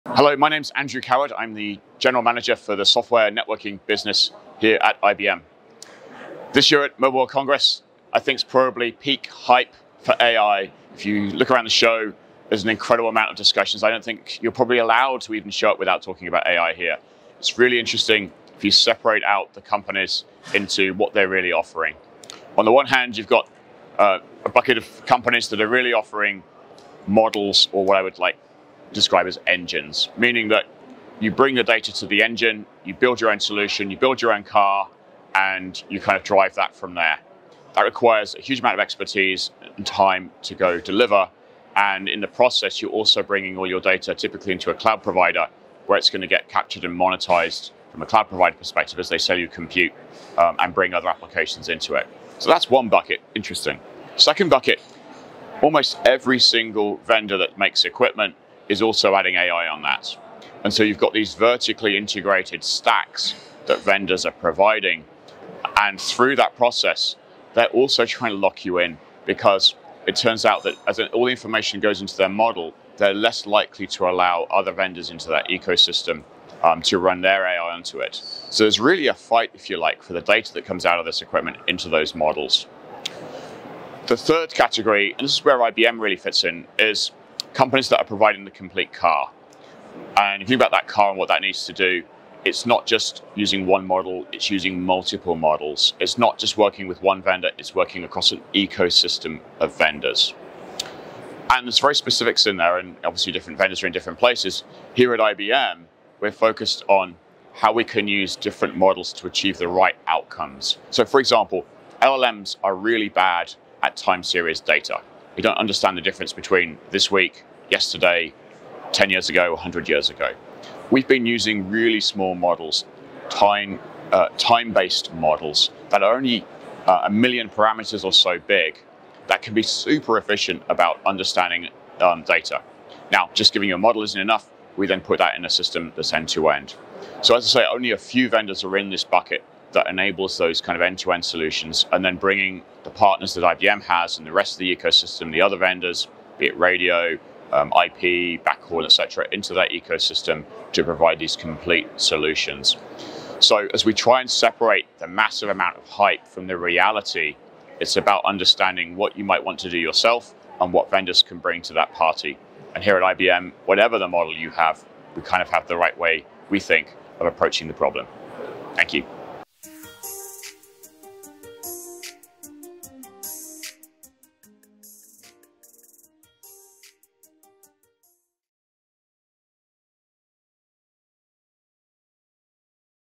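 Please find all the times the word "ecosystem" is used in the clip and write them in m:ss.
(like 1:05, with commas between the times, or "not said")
1:15, 1:38, 2:24, 2:29.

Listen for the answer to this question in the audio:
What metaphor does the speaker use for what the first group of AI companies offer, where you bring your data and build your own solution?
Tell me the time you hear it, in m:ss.
0:29.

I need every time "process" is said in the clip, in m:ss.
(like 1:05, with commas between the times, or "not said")
0:42, 1:06.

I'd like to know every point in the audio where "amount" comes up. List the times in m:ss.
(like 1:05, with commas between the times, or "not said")
0:13, 0:38, 2:35.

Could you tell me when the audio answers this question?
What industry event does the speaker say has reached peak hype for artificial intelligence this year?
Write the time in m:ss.
0:06.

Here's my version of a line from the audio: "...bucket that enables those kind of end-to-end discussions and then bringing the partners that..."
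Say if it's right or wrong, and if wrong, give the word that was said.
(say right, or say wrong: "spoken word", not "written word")
wrong: "solutions", not "discussions".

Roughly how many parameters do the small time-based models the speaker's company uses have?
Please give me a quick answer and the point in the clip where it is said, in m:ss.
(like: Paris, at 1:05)
1 million, at 2:07.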